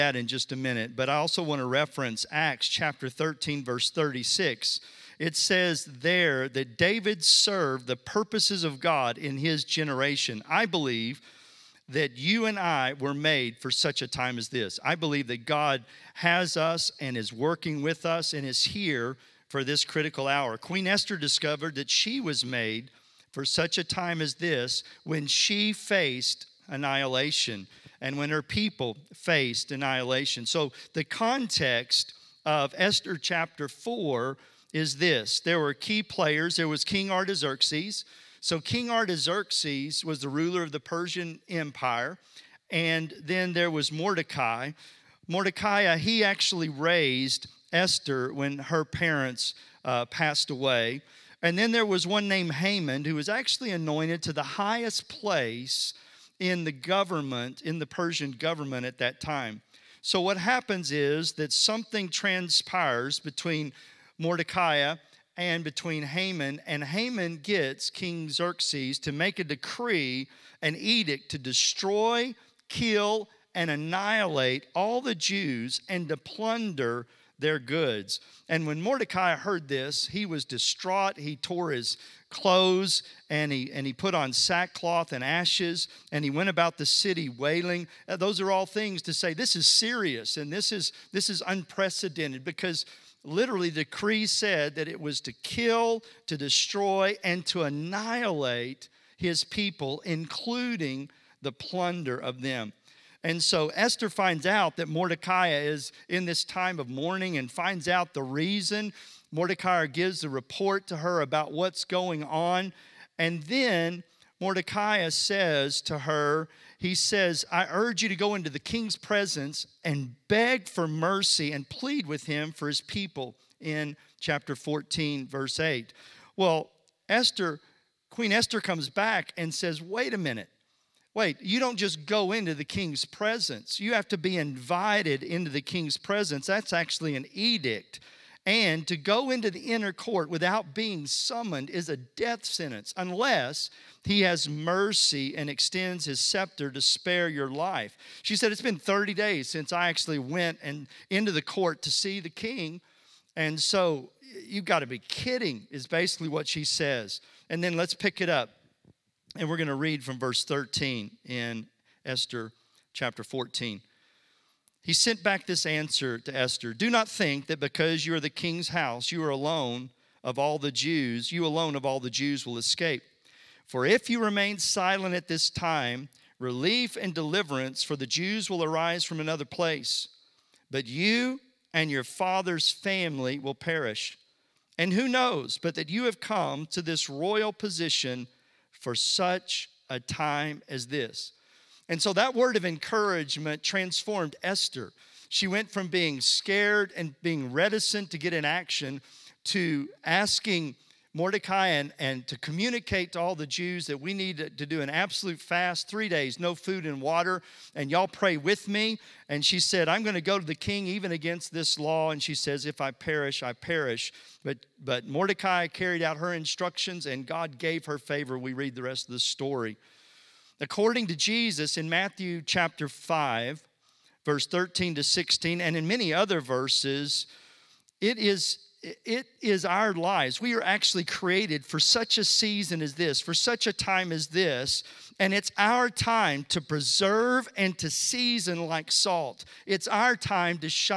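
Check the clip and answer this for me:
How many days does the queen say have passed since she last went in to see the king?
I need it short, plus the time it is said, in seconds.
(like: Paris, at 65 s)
30, at 148 s.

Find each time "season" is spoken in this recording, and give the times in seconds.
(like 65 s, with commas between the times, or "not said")
232 s, 237 s.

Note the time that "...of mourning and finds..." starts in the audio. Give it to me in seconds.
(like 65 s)
106 s.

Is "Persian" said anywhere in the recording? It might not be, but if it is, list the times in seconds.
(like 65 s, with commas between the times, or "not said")
40 s, 57 s.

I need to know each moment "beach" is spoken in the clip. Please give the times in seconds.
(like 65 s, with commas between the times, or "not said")
not said.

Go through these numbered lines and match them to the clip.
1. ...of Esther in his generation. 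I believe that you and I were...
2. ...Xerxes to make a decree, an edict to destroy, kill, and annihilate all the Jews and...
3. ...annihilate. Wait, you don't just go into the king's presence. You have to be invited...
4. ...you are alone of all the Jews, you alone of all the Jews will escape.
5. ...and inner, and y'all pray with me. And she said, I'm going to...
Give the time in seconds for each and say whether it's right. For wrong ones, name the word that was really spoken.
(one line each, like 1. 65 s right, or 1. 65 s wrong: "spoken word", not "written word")
1. 8 s wrong: "God", not "Esther"
2. 68 s right
3. 130 s wrong: "minute", not "annihilate"
4. 169 s right
5. 206 s wrong: "water", not "inner".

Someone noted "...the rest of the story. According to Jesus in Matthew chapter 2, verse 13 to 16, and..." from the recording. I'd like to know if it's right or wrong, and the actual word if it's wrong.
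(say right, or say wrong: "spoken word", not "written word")
wrong: "5", not "2".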